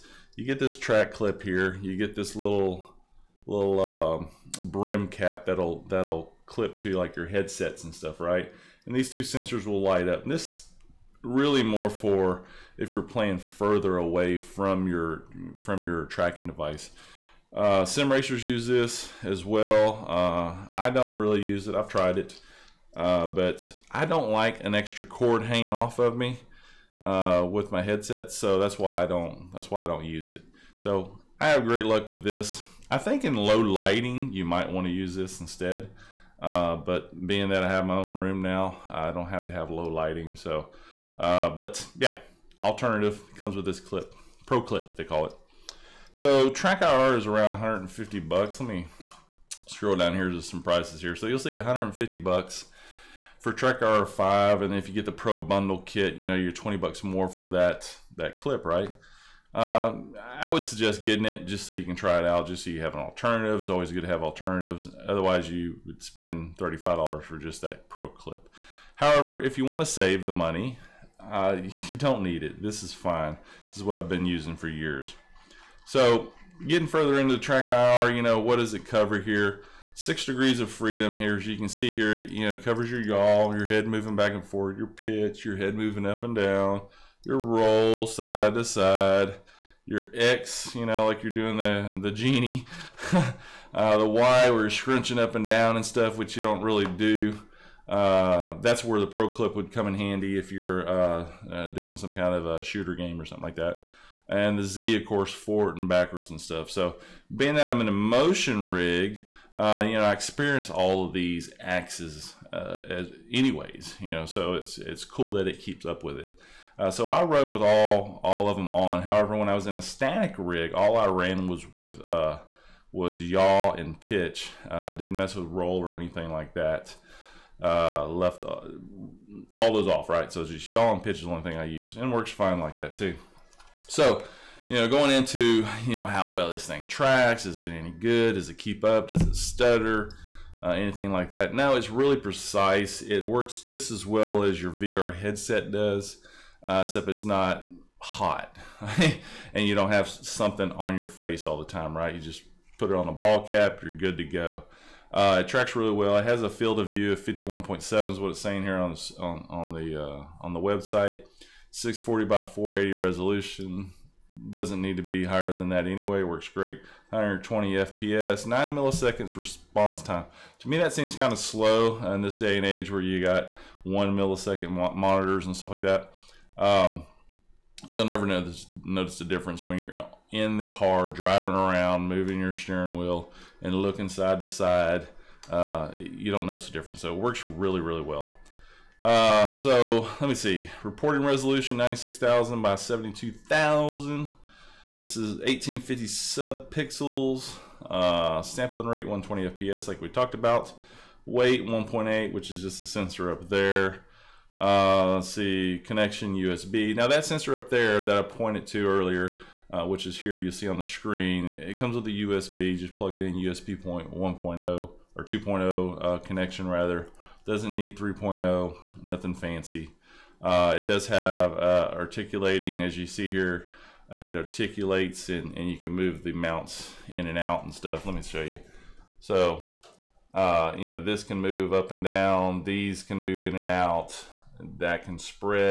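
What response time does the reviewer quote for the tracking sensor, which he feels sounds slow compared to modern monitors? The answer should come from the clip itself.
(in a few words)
9 milliseconds.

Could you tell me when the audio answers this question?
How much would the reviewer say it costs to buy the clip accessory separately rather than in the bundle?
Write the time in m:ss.
1:06.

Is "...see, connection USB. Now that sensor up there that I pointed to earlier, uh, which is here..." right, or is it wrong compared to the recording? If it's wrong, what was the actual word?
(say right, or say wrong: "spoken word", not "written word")
right.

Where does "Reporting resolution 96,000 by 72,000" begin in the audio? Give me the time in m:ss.
3:10.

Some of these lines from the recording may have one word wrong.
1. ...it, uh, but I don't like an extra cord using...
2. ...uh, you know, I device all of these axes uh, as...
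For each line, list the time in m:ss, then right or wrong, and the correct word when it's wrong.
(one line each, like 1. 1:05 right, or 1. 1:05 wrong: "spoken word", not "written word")
1. 0:22 wrong: "hanging", not "using"
2. 1:49 wrong: "experience", not "device".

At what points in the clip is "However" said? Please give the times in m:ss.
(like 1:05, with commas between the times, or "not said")
1:08, 1:59.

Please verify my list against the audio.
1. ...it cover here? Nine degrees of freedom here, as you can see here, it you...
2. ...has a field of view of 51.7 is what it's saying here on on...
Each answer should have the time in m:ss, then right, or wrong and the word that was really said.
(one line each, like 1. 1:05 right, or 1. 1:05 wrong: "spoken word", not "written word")
1. 1:18 wrong: "Six", not "Nine"
2. 2:36 right.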